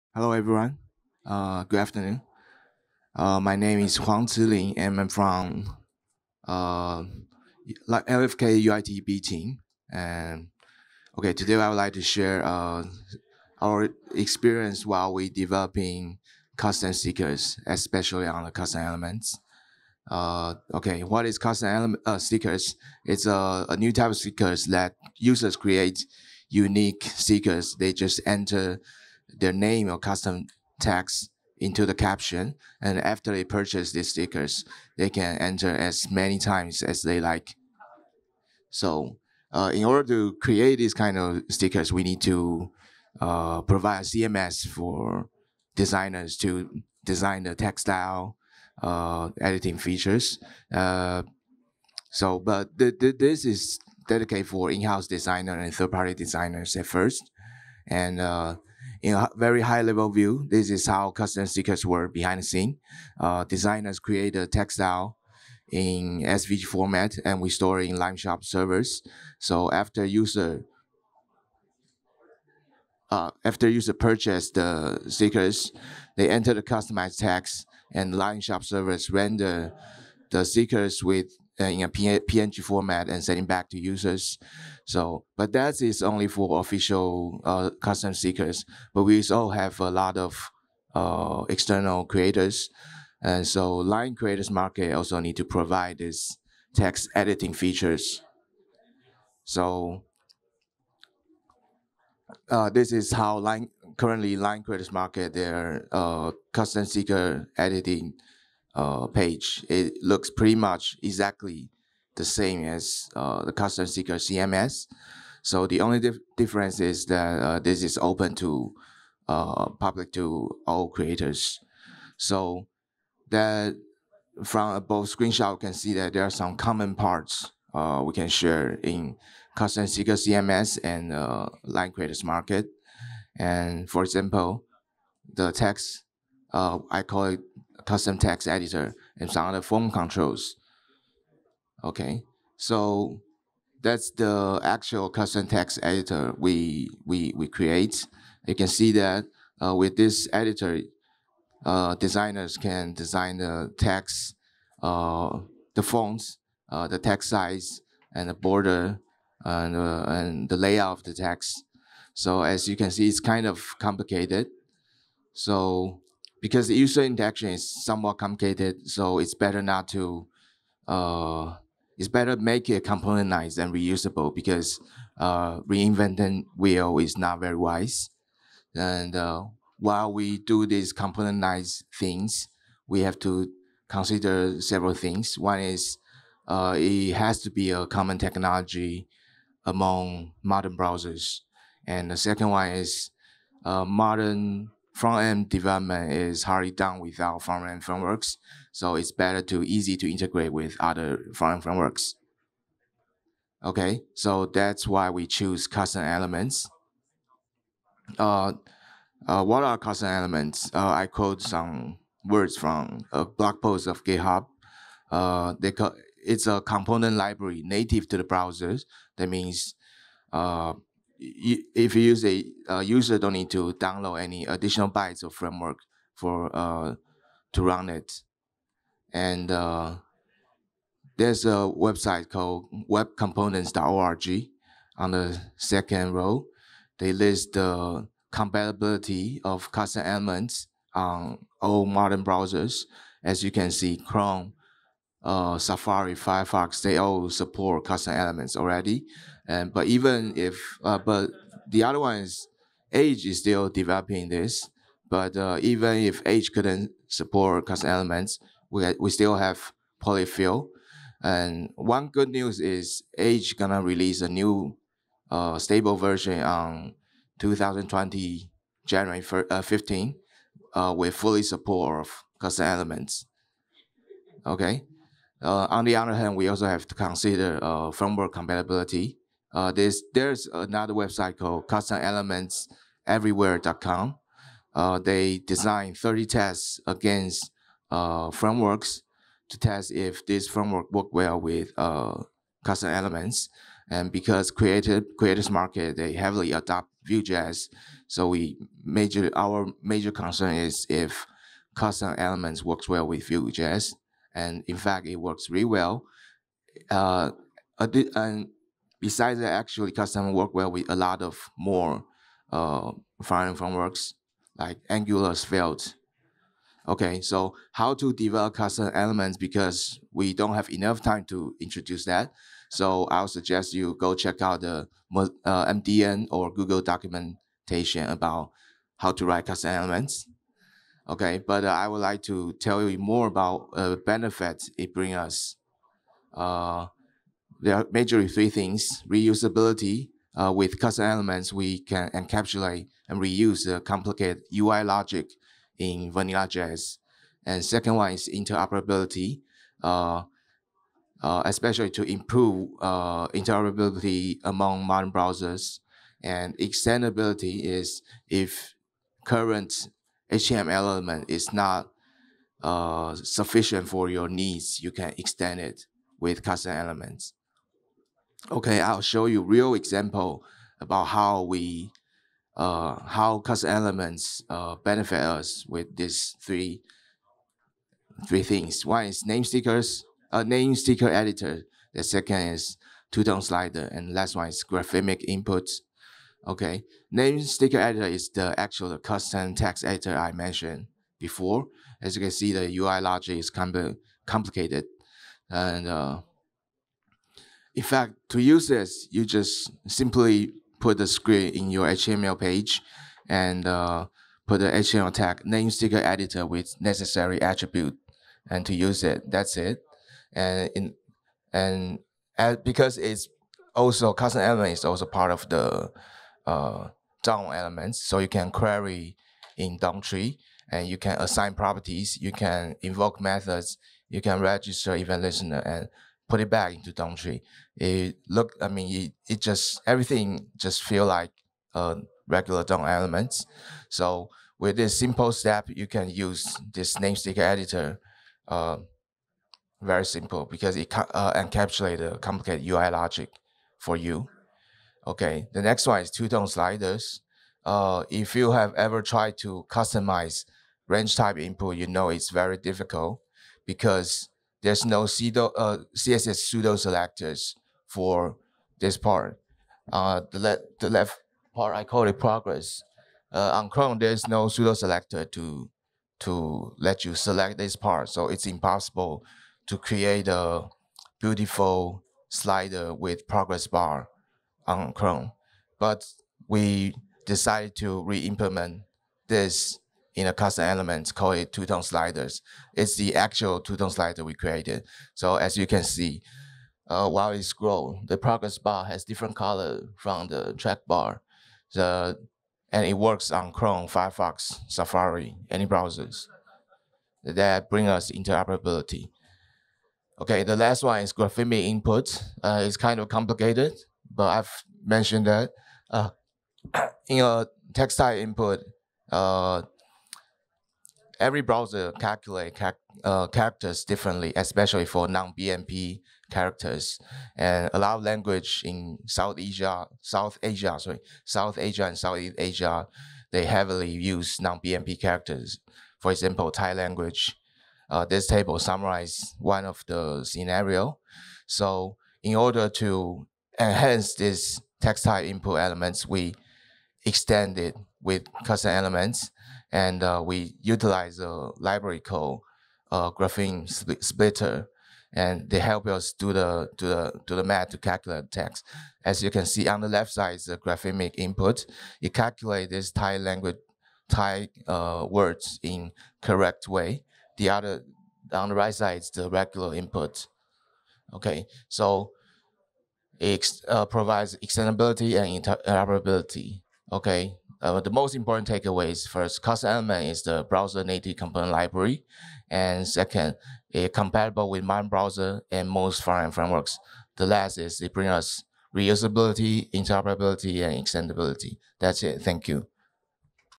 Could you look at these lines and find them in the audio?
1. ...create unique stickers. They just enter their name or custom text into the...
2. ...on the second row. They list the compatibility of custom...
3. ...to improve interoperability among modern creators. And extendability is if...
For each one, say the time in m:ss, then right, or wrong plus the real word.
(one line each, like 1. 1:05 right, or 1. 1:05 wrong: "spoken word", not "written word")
1. 0:25 right
2. 3:54 right
3. 5:51 wrong: "browsers", not "creators".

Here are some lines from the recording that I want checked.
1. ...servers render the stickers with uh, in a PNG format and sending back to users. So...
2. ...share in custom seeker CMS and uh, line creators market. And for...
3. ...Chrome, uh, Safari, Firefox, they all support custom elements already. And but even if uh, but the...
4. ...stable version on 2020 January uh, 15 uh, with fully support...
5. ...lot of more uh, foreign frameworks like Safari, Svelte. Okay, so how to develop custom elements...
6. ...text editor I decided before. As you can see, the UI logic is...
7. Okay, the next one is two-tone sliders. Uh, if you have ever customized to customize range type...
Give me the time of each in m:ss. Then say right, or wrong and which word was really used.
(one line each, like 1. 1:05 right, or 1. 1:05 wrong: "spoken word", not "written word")
1. 1:18 right
2. 2:08 right
3. 4:03 right
4. 4:25 right
5. 5:10 wrong: "Angular", not "Safari"
6. 6:29 wrong: "mentioned", not "decided"
7. 7:25 wrong: "tried", not "customized".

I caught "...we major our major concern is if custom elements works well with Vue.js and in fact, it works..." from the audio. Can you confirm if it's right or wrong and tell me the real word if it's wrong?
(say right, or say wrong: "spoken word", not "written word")
right.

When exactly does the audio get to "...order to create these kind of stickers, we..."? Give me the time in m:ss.
0:39.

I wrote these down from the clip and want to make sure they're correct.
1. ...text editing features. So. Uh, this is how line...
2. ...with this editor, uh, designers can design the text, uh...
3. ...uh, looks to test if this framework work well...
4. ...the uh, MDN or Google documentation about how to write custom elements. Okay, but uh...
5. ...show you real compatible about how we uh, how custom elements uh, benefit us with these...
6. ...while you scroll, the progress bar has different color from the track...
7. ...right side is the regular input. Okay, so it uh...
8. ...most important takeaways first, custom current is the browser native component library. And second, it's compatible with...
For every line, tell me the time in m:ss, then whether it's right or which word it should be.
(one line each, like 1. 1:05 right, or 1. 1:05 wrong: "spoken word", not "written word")
1. 1:36 right
2. 2:29 right
3. 4:47 wrong: "frameworks", not "looks"
4. 5:24 right
5. 6:09 wrong: "example", not "compatible"
6. 8:07 right
7. 9:18 right
8. 9:27 wrong: "element", not "current".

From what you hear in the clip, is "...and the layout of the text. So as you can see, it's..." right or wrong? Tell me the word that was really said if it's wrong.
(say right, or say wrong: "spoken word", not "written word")
right.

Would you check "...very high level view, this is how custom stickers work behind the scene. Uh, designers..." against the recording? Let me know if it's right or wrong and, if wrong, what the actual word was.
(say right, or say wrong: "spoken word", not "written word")
right.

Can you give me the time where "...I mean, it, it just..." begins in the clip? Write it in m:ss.
7:08.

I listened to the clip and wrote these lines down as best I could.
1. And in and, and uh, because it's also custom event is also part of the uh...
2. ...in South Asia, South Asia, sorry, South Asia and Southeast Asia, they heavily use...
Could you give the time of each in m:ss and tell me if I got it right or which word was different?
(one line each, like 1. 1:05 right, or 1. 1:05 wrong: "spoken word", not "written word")
1. 6:50 wrong: "element", not "event"
2. 8:38 right.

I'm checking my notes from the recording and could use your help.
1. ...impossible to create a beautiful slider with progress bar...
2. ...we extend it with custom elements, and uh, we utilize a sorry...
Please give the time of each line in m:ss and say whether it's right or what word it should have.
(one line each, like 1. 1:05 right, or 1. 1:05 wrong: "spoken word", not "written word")
1. 7:48 right
2. 8:56 wrong: "library", not "sorry".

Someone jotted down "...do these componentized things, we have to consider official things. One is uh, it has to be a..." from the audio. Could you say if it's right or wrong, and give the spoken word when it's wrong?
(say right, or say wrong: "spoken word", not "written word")
wrong: "several", not "official".